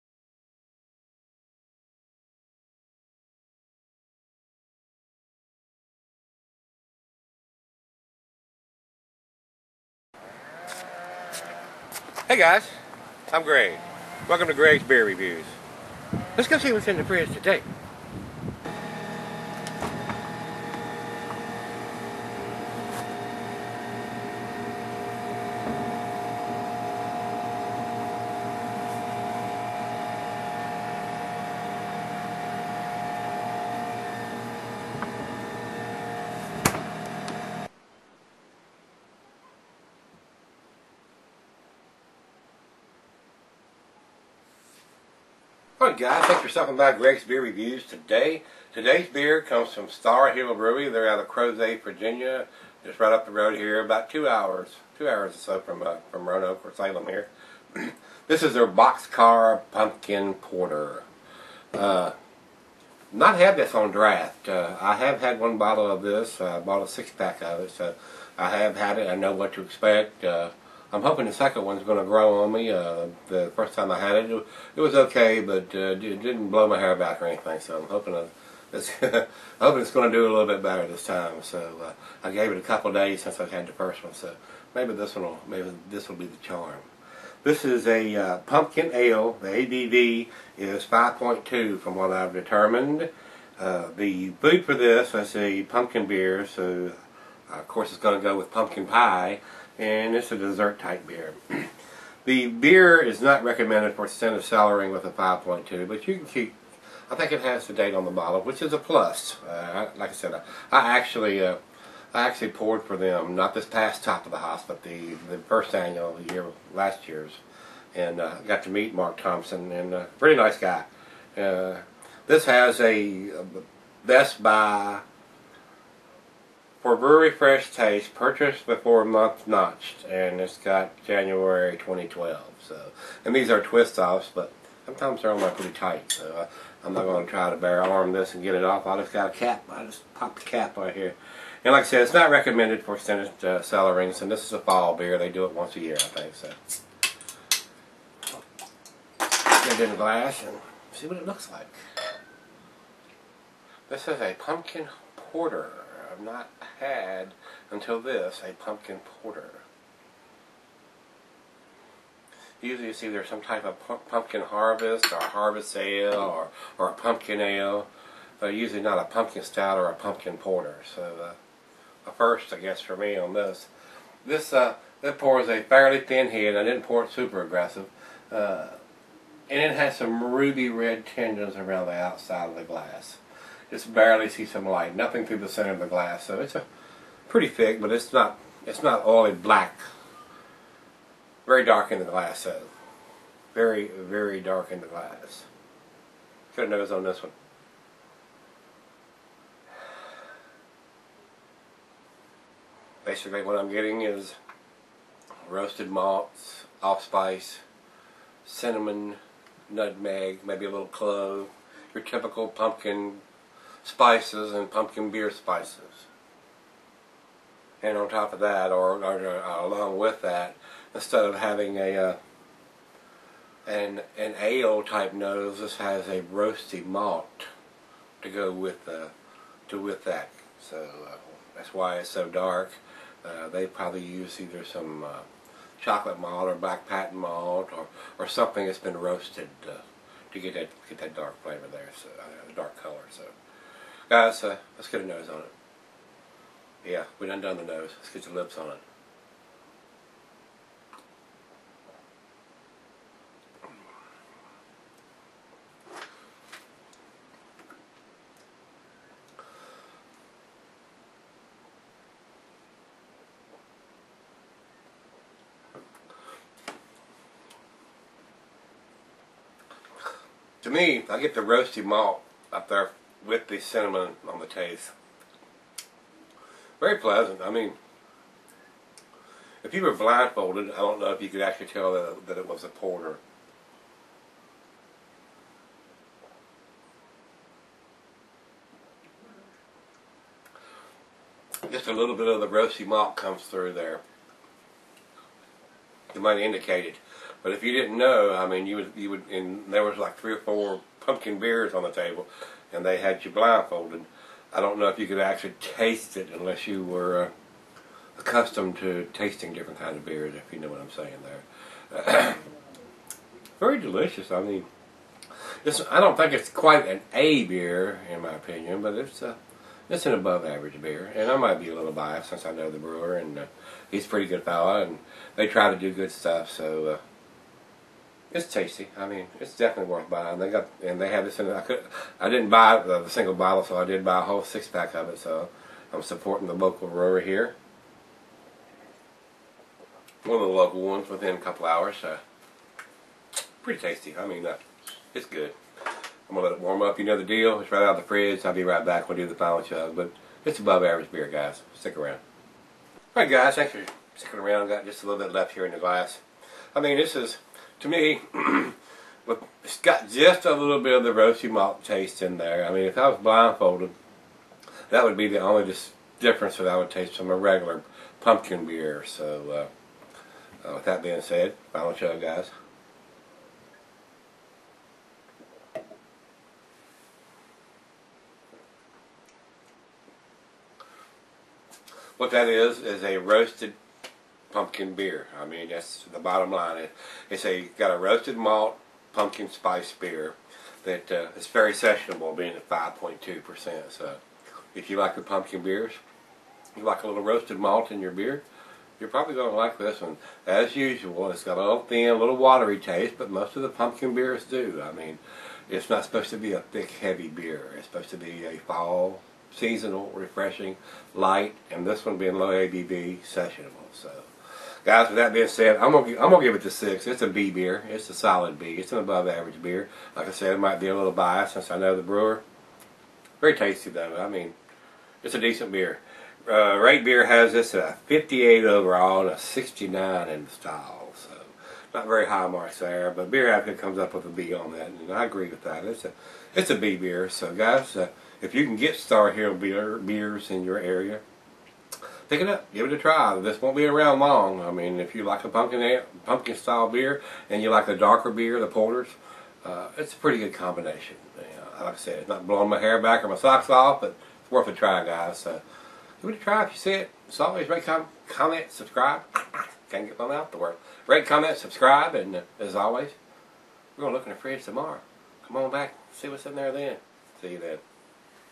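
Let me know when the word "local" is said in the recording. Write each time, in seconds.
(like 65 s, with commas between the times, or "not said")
336 s, 340 s.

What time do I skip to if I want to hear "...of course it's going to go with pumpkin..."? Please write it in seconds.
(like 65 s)
97 s.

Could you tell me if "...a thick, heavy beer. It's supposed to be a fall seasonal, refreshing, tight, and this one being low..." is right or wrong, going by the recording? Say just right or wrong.
wrong.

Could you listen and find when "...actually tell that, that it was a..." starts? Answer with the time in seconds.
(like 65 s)
281 s.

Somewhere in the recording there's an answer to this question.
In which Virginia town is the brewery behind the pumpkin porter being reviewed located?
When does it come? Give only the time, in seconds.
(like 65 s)
51 s.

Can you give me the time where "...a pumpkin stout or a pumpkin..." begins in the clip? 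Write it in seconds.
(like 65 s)
168 s.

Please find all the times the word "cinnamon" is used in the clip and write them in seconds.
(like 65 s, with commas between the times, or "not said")
208 s, 273 s.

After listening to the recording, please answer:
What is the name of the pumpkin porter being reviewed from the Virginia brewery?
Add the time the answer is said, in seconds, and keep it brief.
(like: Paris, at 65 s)
Boxcar, at 58 s.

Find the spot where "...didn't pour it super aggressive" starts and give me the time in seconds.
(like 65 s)
176 s.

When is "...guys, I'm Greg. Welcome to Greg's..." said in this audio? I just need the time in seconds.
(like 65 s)
12 s.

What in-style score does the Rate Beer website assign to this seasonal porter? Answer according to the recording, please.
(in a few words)
69.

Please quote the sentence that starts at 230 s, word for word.
So uh, that's why it's so dark.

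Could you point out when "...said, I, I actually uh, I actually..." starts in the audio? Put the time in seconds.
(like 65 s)
110 s.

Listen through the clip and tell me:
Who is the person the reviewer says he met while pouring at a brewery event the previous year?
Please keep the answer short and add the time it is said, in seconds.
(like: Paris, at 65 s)
Mark Thompson, at 118 s.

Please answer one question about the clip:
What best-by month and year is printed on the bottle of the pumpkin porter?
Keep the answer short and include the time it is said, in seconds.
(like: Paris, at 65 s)
January 2012, at 131 s.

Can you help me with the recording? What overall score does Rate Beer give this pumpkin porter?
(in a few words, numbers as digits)
58.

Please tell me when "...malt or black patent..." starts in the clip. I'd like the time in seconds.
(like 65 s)
236 s.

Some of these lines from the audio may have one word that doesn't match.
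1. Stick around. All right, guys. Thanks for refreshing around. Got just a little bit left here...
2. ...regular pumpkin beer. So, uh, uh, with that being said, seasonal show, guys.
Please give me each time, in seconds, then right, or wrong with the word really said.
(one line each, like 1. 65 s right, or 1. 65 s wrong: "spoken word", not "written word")
1. 351 s wrong: "sticking", not "refreshing"
2. 367 s wrong: "final", not "seasonal".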